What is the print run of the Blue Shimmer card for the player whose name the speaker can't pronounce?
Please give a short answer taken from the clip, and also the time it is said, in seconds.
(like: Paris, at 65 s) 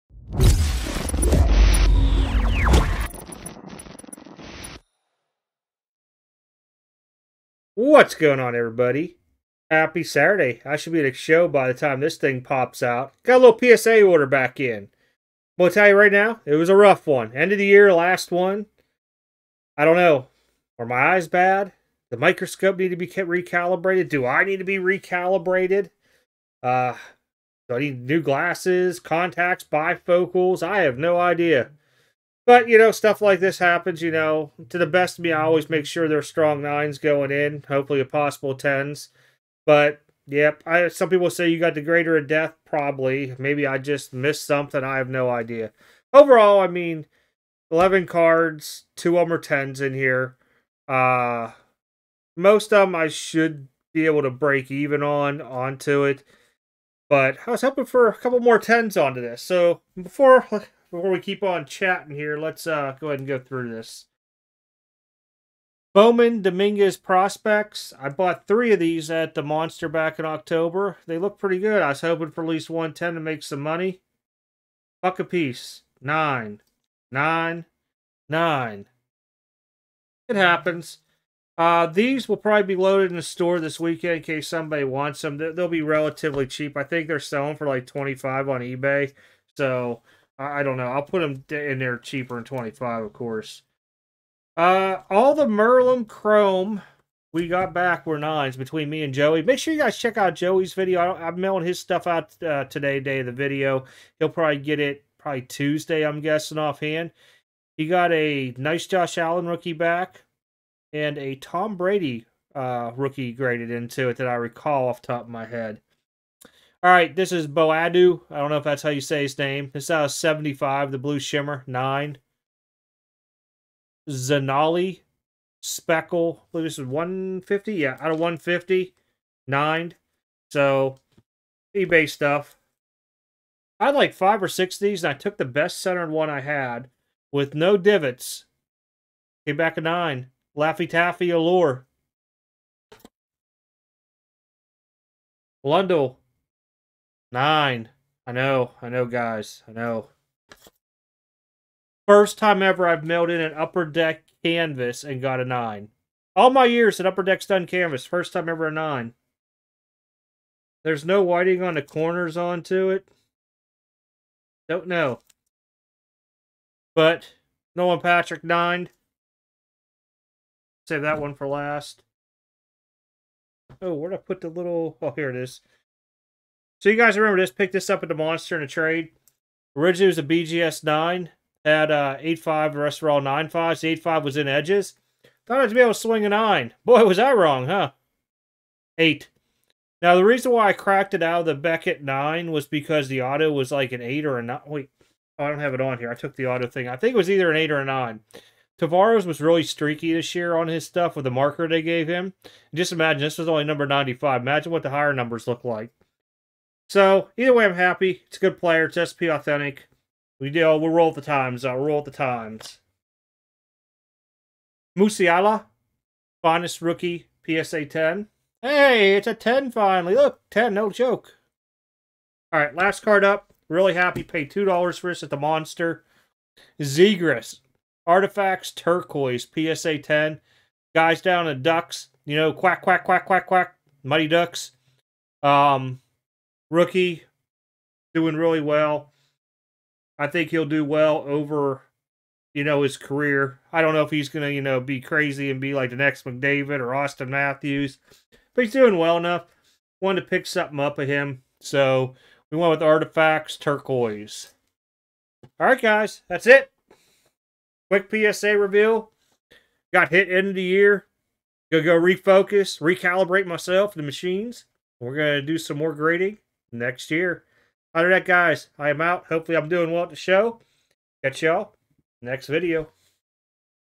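75, at 120 s.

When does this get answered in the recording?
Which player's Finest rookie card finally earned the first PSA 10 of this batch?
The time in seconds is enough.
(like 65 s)
214 s.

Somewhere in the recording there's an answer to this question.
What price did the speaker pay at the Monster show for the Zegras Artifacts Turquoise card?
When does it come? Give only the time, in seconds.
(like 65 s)
224 s.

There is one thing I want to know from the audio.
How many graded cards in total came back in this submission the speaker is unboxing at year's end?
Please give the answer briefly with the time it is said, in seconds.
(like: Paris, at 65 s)
11, at 47 s.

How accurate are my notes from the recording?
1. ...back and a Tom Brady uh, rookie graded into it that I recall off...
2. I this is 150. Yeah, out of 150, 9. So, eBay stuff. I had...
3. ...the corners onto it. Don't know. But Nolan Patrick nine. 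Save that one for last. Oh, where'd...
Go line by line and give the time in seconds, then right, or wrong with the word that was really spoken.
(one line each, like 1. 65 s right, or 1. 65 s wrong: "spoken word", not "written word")
1. 109 s right
2. 126 s right
3. 161 s right.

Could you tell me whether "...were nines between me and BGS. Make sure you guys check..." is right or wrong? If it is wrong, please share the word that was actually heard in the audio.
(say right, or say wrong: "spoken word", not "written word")
wrong: "Joey", not "BGS".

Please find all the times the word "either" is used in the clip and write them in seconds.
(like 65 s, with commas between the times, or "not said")
197 s, 207 s.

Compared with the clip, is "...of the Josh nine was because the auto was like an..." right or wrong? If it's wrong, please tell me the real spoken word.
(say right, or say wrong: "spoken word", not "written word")
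wrong: "Beckett", not "Josh".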